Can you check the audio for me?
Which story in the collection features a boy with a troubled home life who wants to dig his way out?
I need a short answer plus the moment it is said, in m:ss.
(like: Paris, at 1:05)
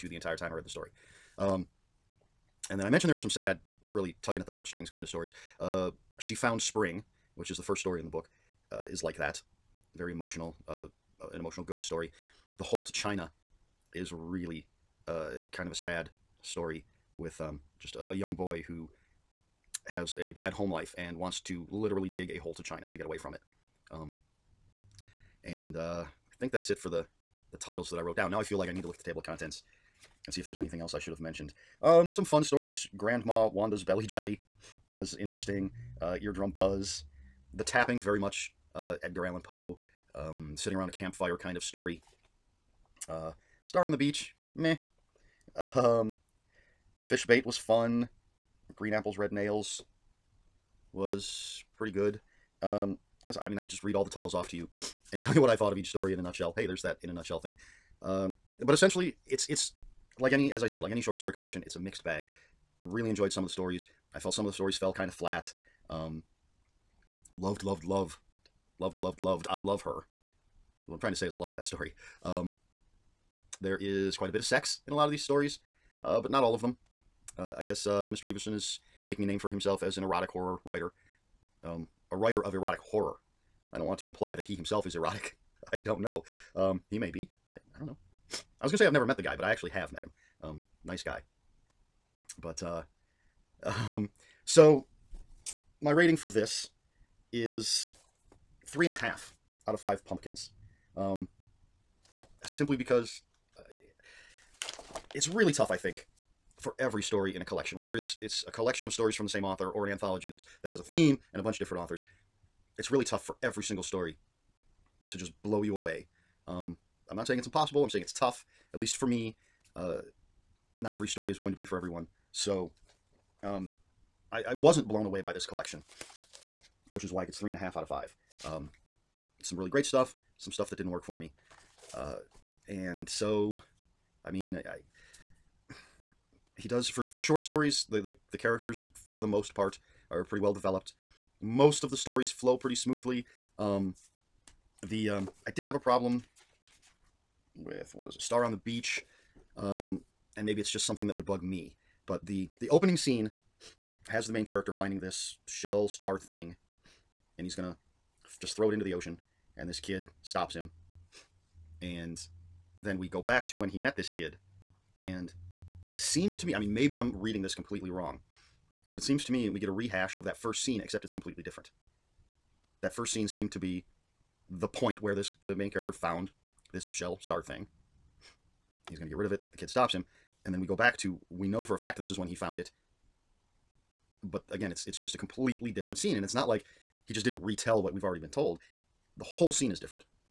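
The Hole to China, at 0:12.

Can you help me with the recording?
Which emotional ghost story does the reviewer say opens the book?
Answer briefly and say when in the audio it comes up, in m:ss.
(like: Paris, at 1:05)
She Found Spring, at 0:06.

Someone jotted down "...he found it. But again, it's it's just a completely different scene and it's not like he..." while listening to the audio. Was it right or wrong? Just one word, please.
right.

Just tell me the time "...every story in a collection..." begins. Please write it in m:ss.
1:46.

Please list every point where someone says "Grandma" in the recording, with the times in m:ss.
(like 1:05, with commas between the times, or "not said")
0:32.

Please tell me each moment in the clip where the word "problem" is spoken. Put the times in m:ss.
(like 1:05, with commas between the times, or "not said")
2:25.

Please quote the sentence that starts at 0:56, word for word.
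Hey, there's that in a nutshell thing.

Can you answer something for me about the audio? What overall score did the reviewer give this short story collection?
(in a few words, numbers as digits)
3.5 out of 5 pumpkins.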